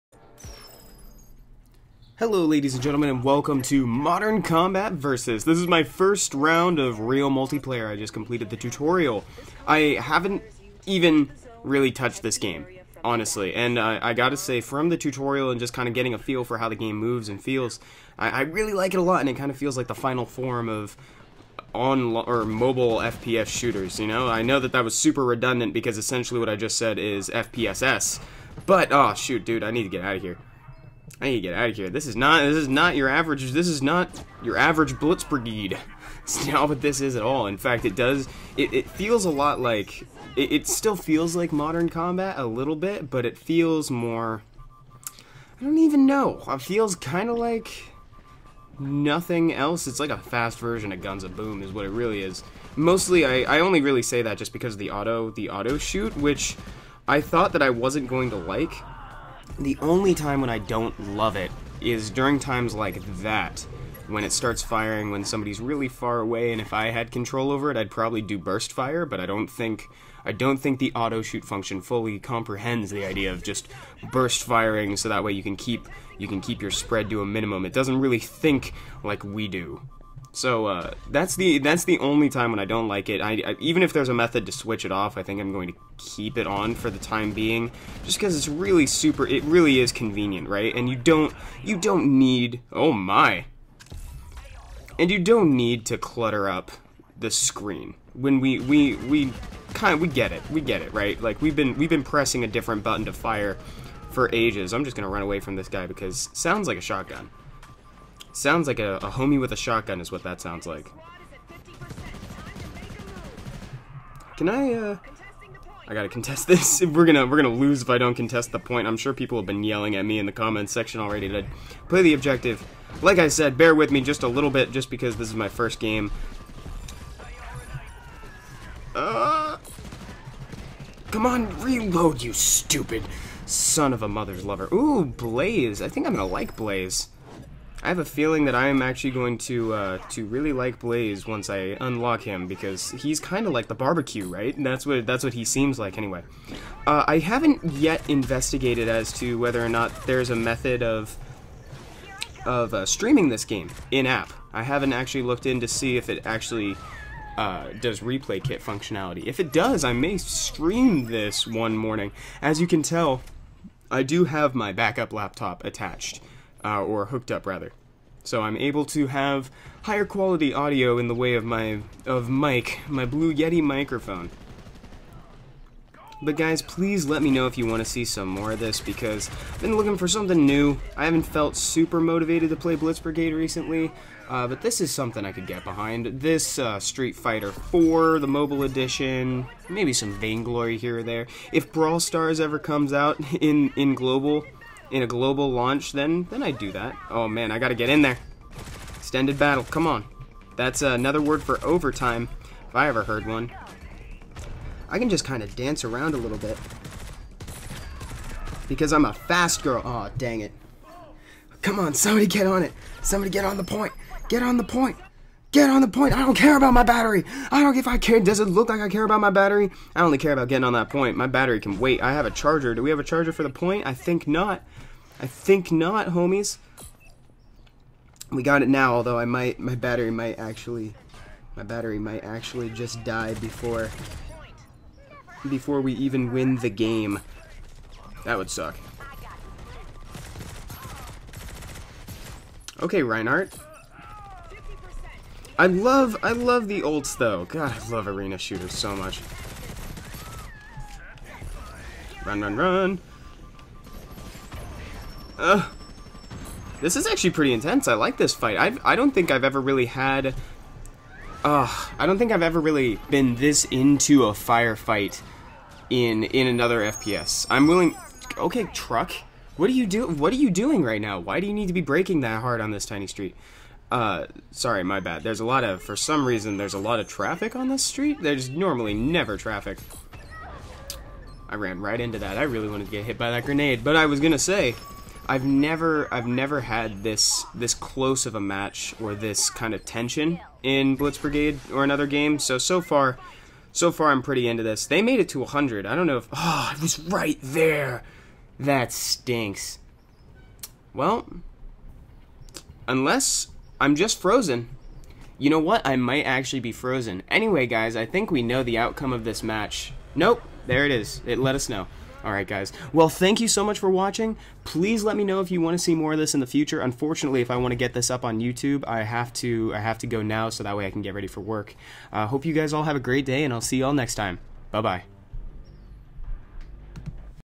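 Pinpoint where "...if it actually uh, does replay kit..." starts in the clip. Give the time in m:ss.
2:35.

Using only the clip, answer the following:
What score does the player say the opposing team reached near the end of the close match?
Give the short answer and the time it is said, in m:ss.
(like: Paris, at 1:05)
100, at 4:55.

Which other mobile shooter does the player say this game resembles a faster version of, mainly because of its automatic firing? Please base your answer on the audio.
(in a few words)
Guns of Boom.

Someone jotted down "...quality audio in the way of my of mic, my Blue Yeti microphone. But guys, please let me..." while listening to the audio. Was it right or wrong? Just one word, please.
right.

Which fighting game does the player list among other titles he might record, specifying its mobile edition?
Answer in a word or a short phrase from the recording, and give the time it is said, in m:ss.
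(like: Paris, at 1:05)
Street Fighter 4, at 3:06.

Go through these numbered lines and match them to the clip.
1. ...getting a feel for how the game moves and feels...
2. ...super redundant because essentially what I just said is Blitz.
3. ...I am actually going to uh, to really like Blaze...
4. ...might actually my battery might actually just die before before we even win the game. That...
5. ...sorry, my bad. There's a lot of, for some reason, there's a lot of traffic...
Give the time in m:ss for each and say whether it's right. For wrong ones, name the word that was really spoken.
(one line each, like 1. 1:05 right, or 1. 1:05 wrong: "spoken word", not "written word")
1. 0:15 right
2. 0:24 wrong: "FPSS", not "Blitz"
3. 2:18 right
4. 3:50 right
5. 4:34 right.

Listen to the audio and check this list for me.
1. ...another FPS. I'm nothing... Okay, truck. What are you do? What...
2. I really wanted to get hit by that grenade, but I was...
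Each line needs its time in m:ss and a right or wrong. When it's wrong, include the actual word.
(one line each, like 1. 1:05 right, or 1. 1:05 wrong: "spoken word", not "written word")
1. 4:26 wrong: "willing", not "nothing"
2. 4:42 right.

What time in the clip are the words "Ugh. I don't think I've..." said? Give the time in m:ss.
4:21.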